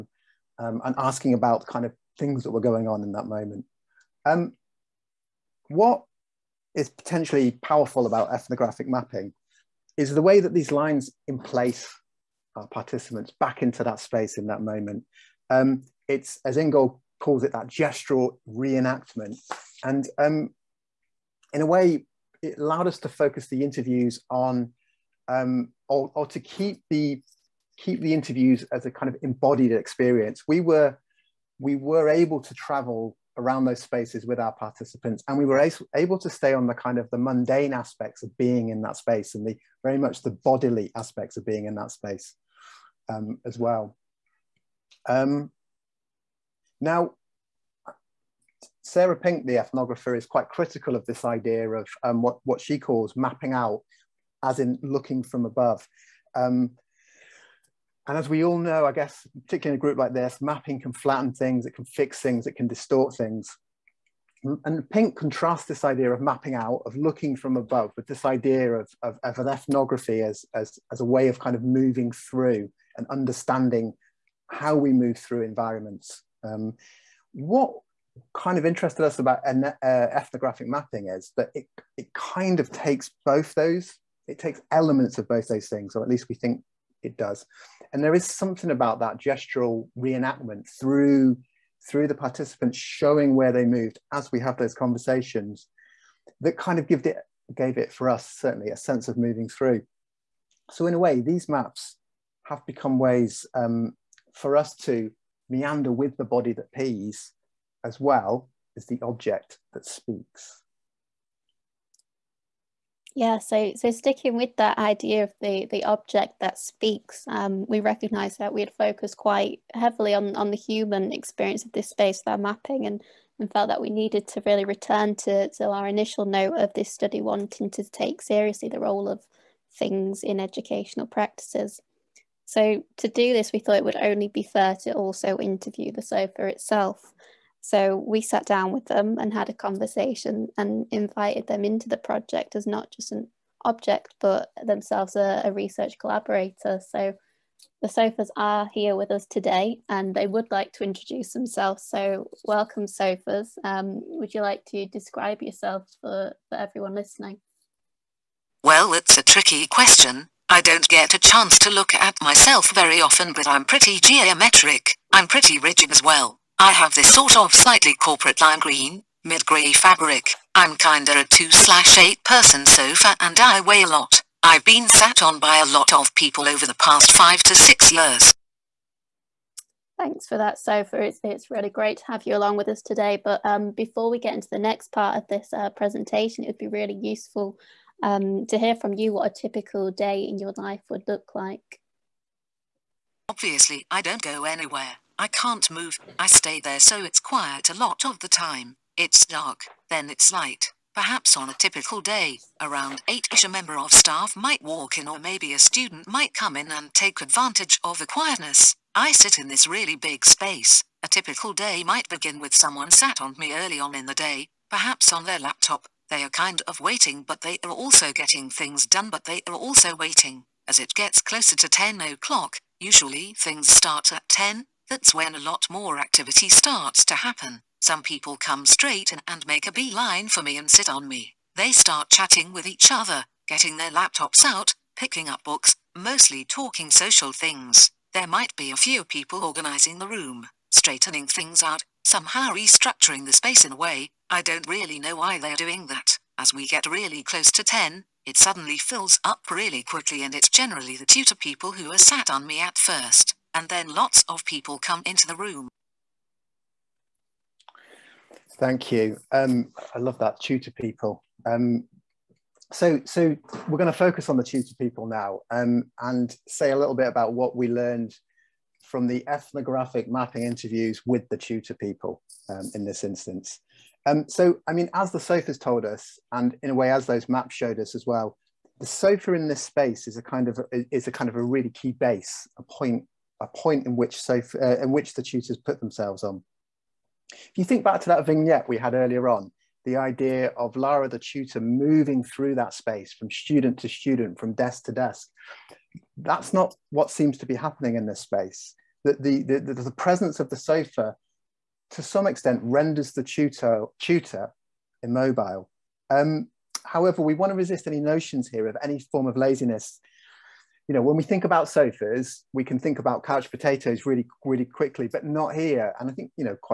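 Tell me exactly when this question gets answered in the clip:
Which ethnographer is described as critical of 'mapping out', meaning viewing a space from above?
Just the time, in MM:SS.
00:48.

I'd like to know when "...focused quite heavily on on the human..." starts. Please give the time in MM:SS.
01:58.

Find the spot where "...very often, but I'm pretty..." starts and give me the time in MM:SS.
02:42.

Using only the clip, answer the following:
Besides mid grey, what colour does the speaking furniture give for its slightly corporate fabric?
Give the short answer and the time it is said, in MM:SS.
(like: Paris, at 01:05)
lime green, at 02:48.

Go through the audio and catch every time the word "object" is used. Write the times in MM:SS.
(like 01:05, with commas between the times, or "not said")
01:49, 01:55, 02:23.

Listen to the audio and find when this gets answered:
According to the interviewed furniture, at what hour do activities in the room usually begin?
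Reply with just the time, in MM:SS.
03:41.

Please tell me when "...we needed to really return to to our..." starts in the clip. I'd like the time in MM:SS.
02:03.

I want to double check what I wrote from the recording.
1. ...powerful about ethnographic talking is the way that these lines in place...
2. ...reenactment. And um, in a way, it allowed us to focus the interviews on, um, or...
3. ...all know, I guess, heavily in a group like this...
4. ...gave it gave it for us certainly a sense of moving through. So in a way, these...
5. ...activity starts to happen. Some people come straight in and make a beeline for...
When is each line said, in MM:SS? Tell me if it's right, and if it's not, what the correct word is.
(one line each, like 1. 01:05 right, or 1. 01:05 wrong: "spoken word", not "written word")
1. 00:07 wrong: "mapping", not "talking"
2. 00:18 right
3. 00:58 wrong: "particularly", not "heavily"
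4. 01:36 right
5. 03:45 right.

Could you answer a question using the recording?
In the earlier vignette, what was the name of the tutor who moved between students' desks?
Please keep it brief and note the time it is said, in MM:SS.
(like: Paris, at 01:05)
Lara, at 04:50.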